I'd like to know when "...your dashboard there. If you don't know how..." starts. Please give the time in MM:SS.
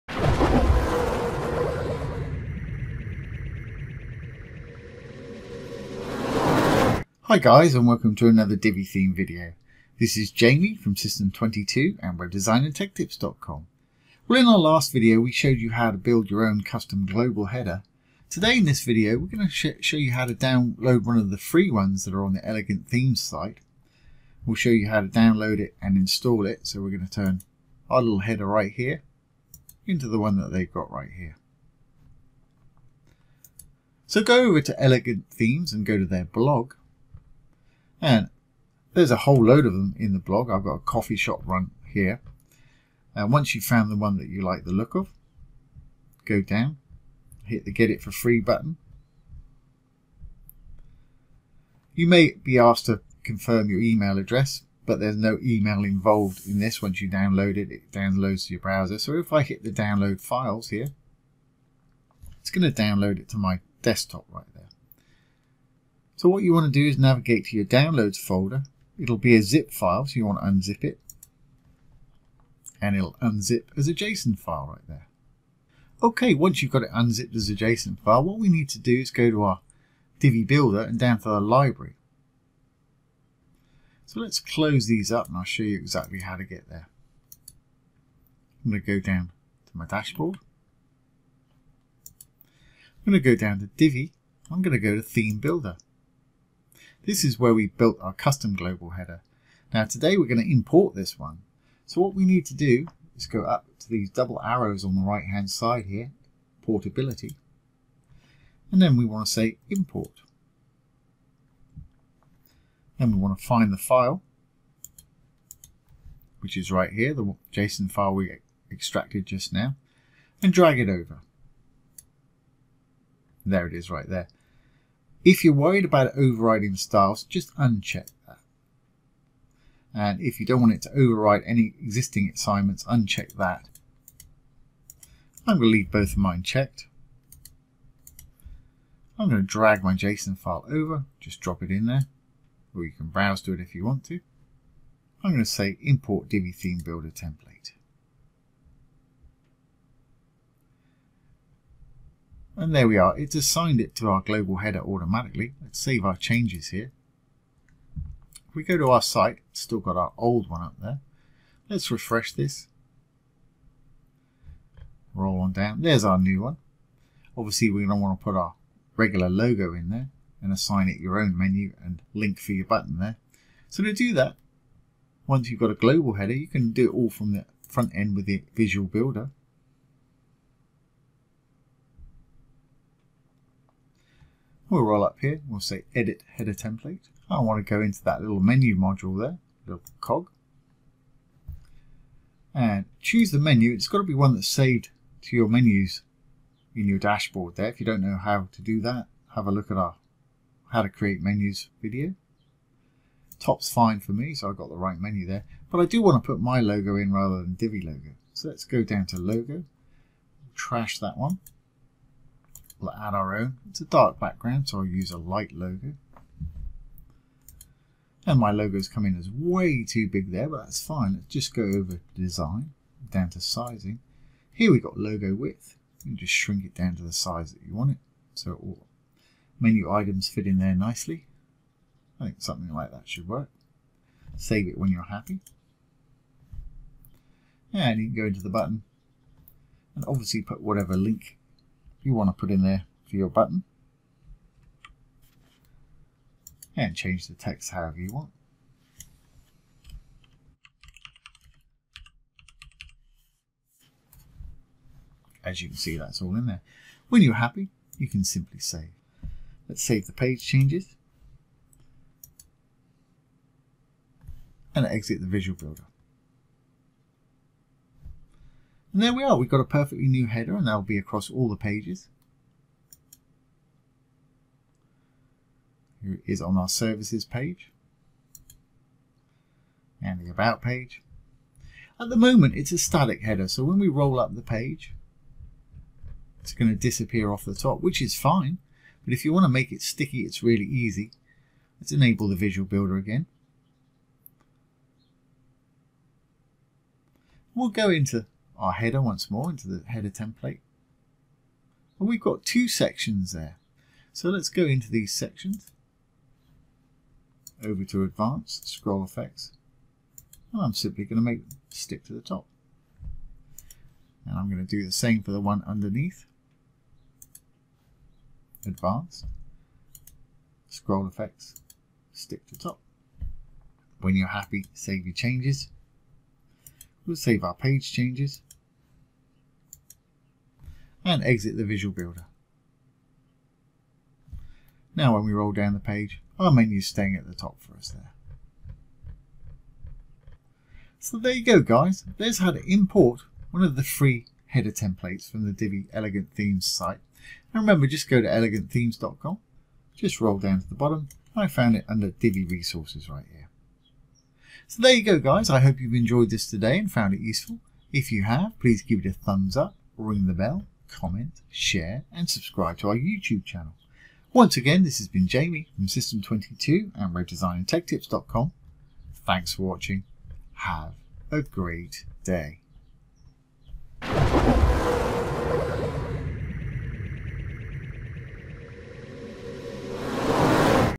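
03:16.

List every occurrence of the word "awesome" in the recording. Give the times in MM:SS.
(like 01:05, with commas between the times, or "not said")
not said.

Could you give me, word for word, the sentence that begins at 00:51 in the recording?
You may be asked to confirm your email address, but there's no email involved in this.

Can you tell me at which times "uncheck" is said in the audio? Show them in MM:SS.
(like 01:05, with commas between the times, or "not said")
02:07, 02:12.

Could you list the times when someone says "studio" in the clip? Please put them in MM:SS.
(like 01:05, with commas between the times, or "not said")
not said.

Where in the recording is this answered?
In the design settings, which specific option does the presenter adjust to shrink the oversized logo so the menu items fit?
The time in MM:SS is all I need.
03:44.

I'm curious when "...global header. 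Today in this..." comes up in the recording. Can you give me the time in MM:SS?
00:17.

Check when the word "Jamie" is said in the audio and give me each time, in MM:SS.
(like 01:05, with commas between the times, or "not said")
00:10, 06:05.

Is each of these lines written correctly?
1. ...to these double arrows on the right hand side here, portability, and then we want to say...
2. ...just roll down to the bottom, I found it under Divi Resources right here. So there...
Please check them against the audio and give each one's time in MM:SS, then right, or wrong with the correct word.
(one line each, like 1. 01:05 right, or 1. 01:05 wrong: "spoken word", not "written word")
1. 01:43 right
2. 05:49 right.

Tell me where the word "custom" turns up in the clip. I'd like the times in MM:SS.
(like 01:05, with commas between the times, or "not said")
00:16, 01:38.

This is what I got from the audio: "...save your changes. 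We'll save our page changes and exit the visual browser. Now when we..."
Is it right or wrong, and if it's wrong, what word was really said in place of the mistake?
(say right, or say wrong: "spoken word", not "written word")
wrong: "builder", not "browser".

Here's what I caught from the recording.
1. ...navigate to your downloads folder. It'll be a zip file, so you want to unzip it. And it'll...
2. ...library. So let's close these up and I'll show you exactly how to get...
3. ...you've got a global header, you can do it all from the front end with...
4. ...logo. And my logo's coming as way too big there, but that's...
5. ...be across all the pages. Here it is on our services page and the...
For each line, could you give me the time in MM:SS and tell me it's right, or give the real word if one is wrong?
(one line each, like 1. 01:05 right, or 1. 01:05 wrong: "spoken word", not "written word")
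1. 01:06 right
2. 01:21 right
3. 02:55 right
4. 03:35 right
5. 04:30 right.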